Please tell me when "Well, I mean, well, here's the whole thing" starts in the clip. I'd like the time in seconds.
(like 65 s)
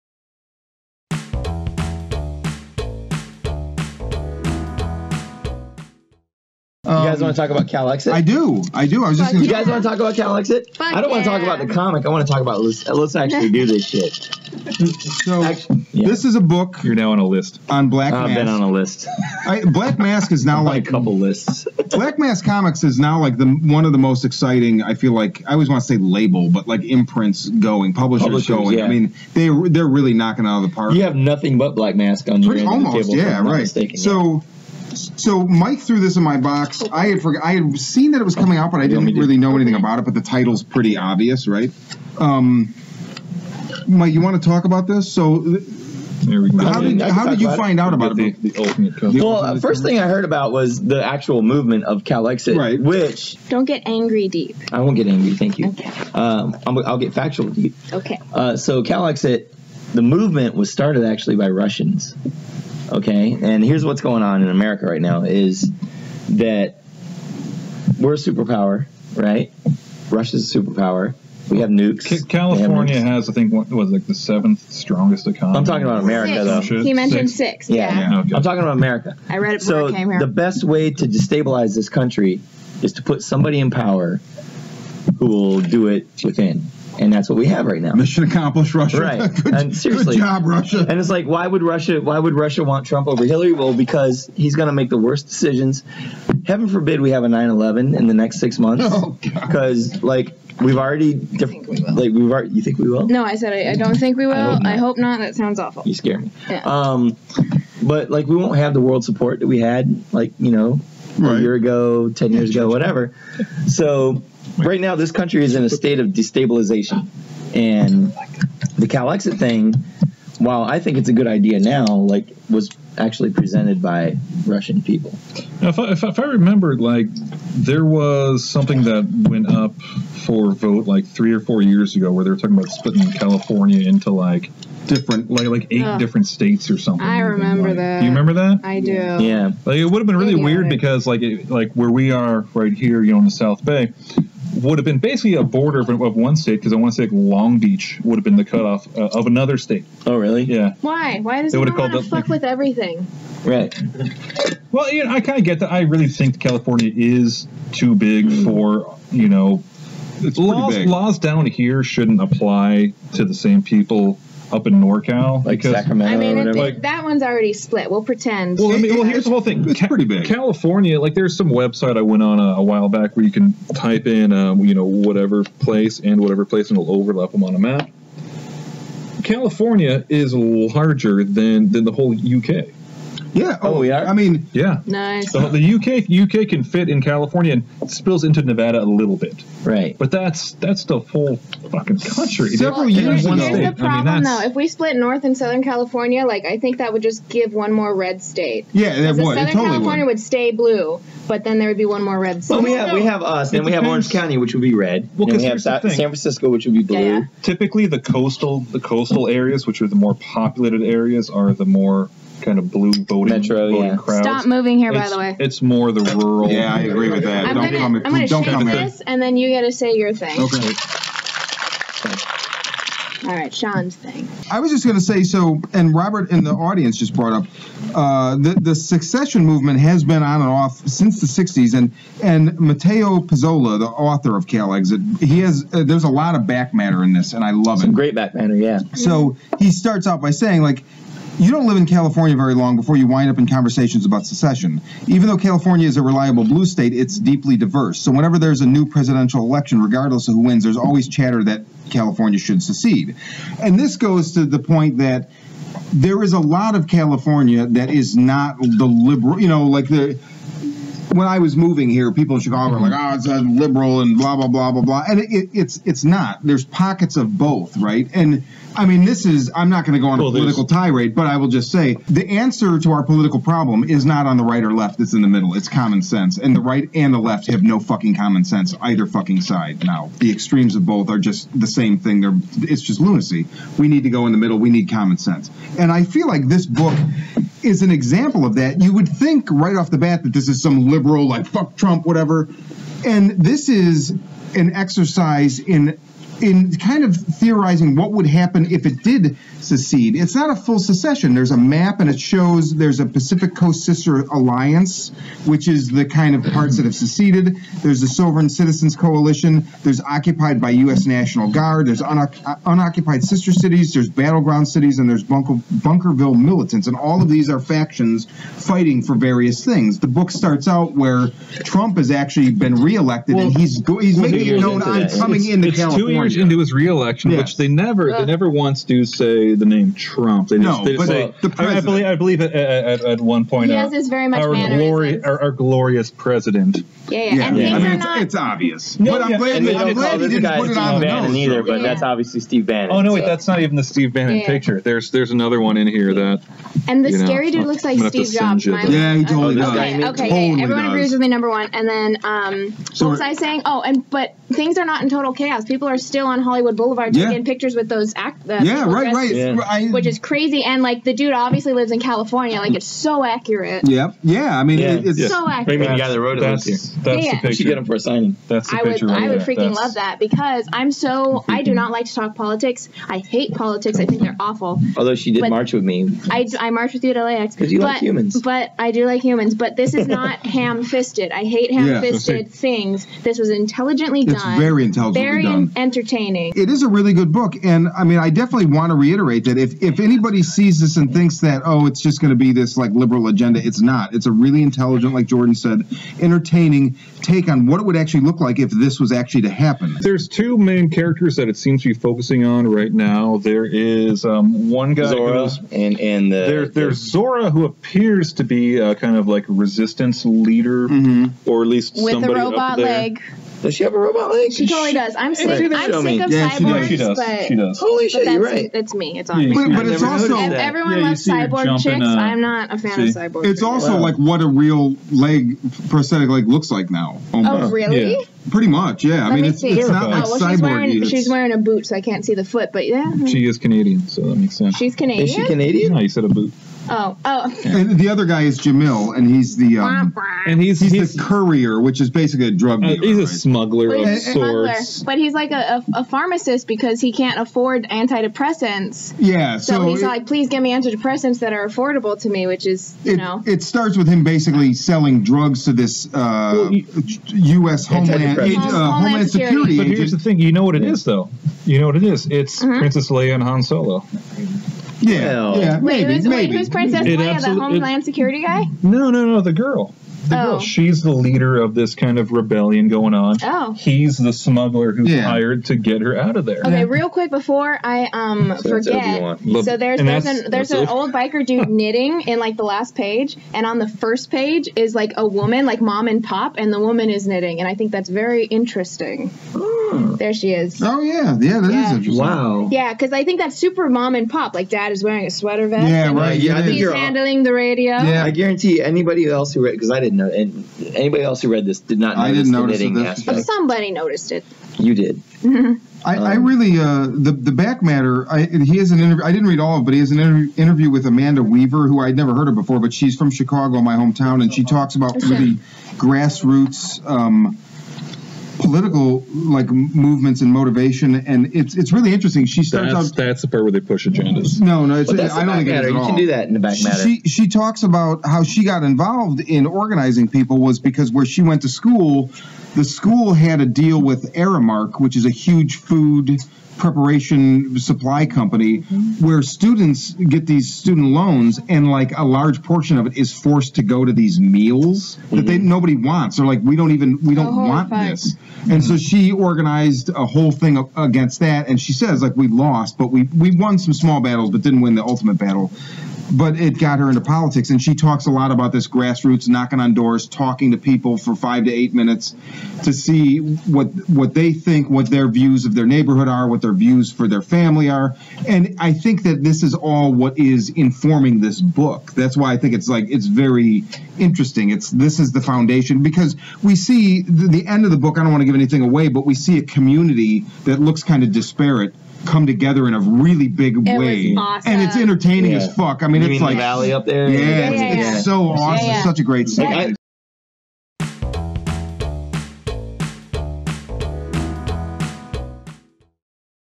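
168 s.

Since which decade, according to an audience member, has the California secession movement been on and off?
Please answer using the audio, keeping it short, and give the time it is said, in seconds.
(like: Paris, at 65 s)
the '60s, at 231 s.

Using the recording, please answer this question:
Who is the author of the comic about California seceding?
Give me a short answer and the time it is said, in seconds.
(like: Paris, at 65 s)
Matteo Pizzolo, at 232 s.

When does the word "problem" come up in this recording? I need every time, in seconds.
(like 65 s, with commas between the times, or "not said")
193 s, 273 s.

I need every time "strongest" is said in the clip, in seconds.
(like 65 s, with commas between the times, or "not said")
74 s.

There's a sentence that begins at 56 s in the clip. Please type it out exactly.
Um, i will get factual deep.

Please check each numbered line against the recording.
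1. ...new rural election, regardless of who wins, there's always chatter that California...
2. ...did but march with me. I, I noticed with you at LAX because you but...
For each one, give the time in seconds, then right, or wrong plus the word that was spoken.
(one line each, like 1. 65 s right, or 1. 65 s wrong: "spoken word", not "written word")
1. 248 s wrong: "presidential", not "rural"
2. 375 s wrong: "marched", not "noticed".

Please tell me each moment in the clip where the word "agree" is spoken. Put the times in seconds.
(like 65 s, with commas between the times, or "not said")
216 s, 350 s.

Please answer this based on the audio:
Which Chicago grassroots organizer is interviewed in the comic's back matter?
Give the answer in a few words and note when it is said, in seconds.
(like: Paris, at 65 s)
Amanda Weaver, at 511 s.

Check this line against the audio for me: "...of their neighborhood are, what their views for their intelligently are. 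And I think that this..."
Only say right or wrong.
wrong.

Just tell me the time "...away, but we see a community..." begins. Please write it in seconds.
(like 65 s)
578 s.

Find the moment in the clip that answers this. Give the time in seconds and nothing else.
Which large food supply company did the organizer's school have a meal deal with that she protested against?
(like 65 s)
534 s.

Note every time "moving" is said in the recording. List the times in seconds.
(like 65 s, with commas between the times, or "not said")
214 s, 261 s.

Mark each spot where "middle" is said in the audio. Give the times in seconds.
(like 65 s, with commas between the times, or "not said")
275 s, 284 s.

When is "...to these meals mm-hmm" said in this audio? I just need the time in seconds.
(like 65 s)
544 s.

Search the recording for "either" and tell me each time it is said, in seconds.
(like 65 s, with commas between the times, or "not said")
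278 s, 341 s.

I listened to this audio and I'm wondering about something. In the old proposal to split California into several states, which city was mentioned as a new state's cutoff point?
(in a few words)
Long Beach.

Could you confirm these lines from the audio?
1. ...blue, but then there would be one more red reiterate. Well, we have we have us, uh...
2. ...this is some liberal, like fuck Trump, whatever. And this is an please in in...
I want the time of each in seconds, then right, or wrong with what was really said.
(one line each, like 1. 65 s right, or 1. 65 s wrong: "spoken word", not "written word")
1. 200 s wrong: "state", not "reiterate"
2. 290 s wrong: "exercise", not "please".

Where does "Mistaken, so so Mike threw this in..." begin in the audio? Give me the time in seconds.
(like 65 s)
33 s.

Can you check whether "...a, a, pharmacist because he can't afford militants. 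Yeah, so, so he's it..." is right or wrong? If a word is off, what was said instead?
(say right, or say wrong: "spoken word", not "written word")
wrong: "antidepressants", not "militants".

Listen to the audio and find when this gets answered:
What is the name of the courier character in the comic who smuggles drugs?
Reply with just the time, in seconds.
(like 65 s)
438 s.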